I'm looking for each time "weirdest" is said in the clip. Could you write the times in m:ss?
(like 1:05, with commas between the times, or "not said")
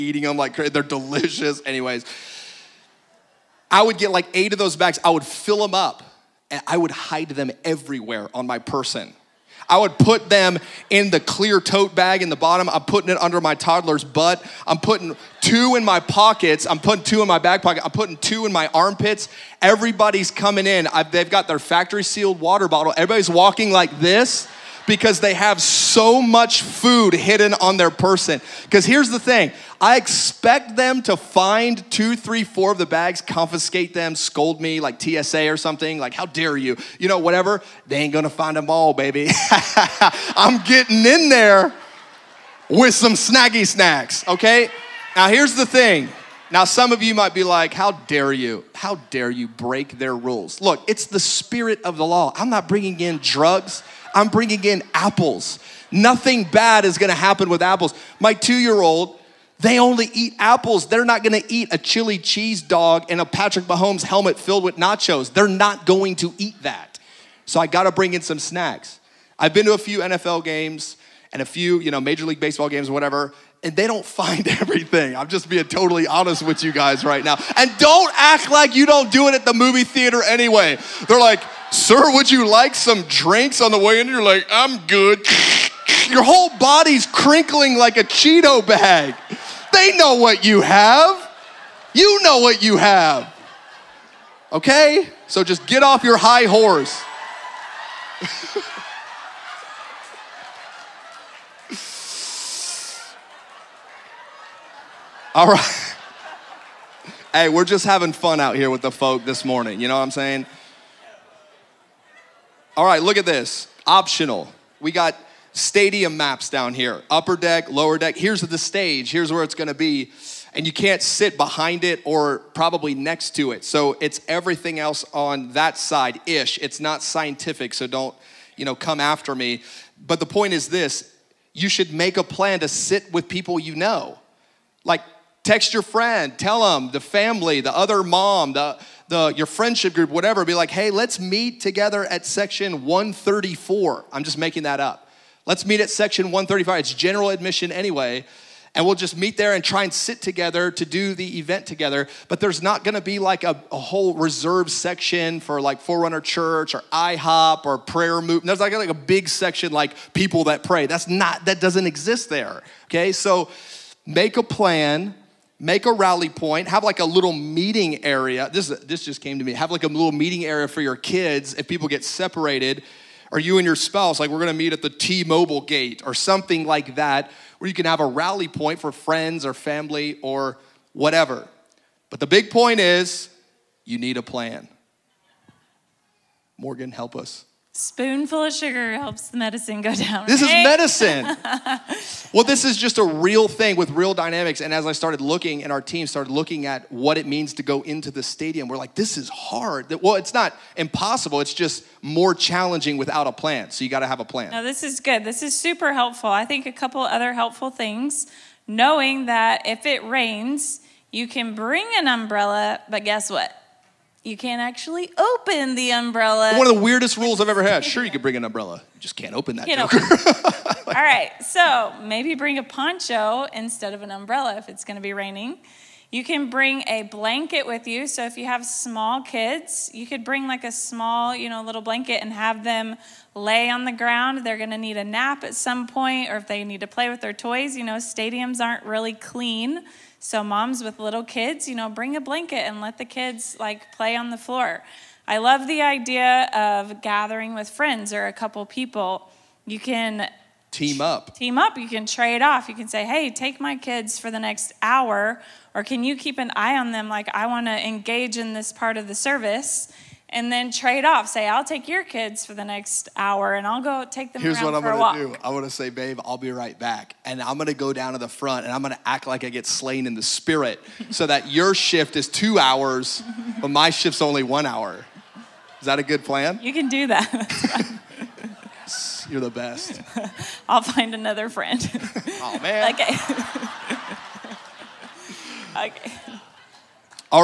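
3:36.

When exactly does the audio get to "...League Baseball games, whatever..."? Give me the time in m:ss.
1:12.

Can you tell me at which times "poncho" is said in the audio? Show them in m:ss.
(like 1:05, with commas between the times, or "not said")
3:42.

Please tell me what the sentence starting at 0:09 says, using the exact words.
I would put them in the clear tote bag in the bottom.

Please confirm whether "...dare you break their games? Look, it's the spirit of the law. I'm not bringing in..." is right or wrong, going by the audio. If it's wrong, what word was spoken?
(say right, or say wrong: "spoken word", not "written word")
wrong: "rules", not "games".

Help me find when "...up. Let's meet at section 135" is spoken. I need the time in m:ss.
2:24.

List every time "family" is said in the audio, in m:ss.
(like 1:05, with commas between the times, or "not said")
2:16, 2:59.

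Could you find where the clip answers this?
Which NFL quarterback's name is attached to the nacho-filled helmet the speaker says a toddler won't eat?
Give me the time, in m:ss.
1:03.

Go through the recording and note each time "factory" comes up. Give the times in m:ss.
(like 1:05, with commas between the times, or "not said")
0:21.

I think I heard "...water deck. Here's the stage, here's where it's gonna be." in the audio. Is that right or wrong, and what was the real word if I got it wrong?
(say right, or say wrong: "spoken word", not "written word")
wrong: "lower", not "water".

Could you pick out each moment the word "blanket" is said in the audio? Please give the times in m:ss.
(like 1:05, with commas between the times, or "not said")
3:47, 3:51, 4:02.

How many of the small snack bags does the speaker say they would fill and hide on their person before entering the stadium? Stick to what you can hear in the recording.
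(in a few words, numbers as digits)
8.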